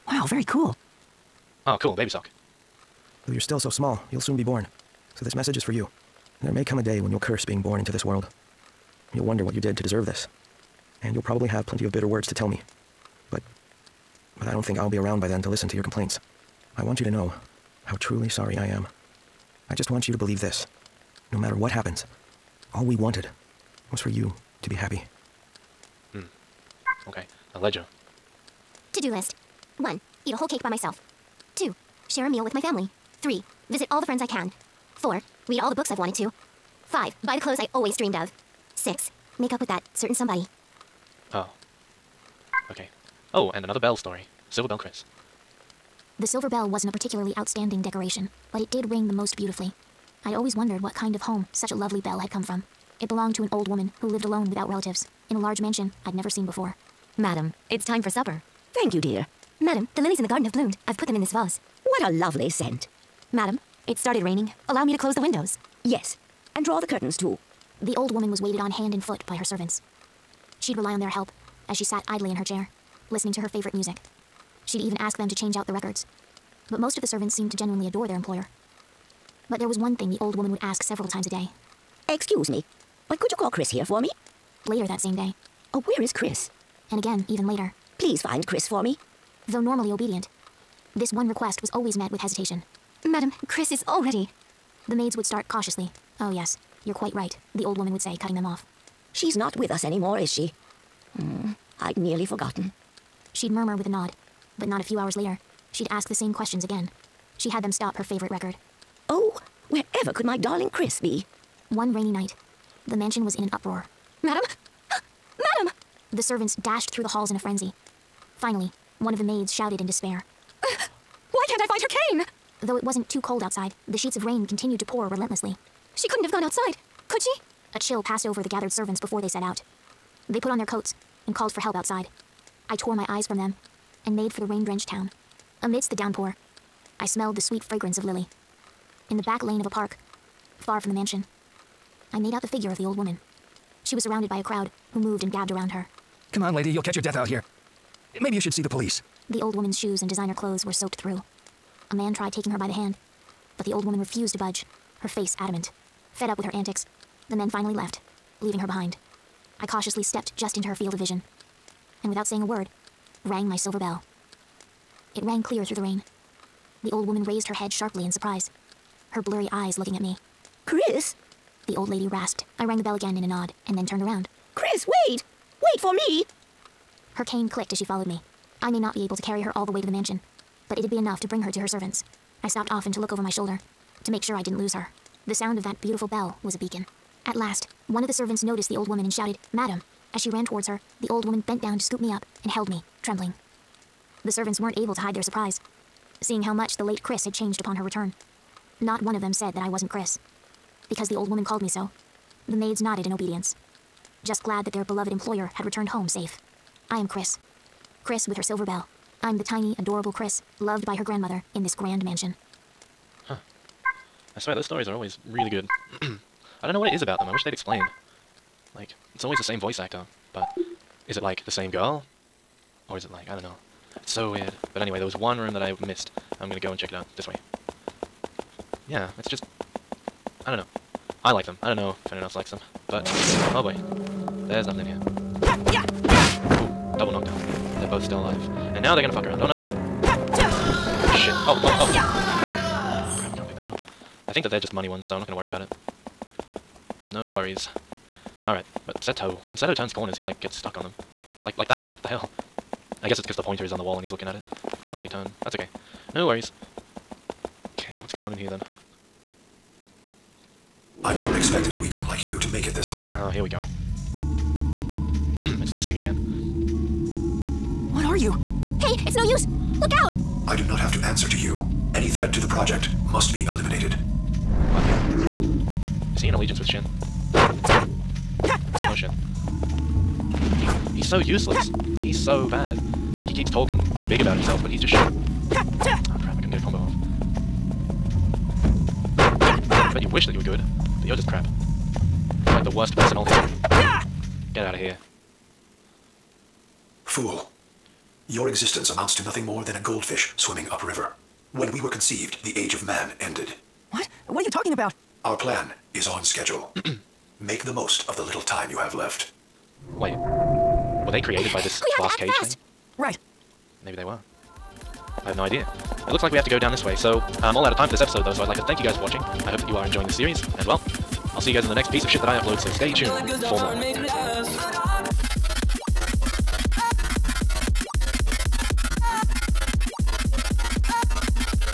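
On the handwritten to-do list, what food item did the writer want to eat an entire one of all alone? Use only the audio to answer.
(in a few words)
A whole cake.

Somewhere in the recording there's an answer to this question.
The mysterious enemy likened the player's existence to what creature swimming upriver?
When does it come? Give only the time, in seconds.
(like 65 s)
299 s.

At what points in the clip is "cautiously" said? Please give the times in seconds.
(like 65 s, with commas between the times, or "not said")
95 s, 159 s.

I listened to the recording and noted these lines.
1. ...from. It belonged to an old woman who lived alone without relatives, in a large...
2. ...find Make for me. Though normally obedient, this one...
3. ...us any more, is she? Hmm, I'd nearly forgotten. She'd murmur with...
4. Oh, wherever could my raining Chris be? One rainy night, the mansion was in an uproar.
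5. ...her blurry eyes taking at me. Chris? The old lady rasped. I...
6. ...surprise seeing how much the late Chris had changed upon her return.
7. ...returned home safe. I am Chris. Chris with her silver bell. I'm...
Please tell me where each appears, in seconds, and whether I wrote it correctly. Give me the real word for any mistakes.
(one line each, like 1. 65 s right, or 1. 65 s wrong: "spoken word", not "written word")
1. 52 s right
2. 88 s wrong: "Chris", not "Make"
3. 99 s right
4. 109 s wrong: "darling", not "raining"
5. 169 s wrong: "looking", not "taking"
6. 195 s right
7. 205 s right.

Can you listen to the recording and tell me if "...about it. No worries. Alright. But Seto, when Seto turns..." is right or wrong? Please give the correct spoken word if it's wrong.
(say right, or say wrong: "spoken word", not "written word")
right.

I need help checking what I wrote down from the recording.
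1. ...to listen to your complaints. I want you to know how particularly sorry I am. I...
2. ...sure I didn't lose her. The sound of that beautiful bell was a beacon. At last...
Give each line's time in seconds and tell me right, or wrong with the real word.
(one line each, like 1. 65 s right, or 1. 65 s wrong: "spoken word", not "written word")
1. 15 s wrong: "truly", not "particularly"
2. 184 s right.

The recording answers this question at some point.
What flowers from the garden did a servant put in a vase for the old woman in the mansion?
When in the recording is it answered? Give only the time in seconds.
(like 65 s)
60 s.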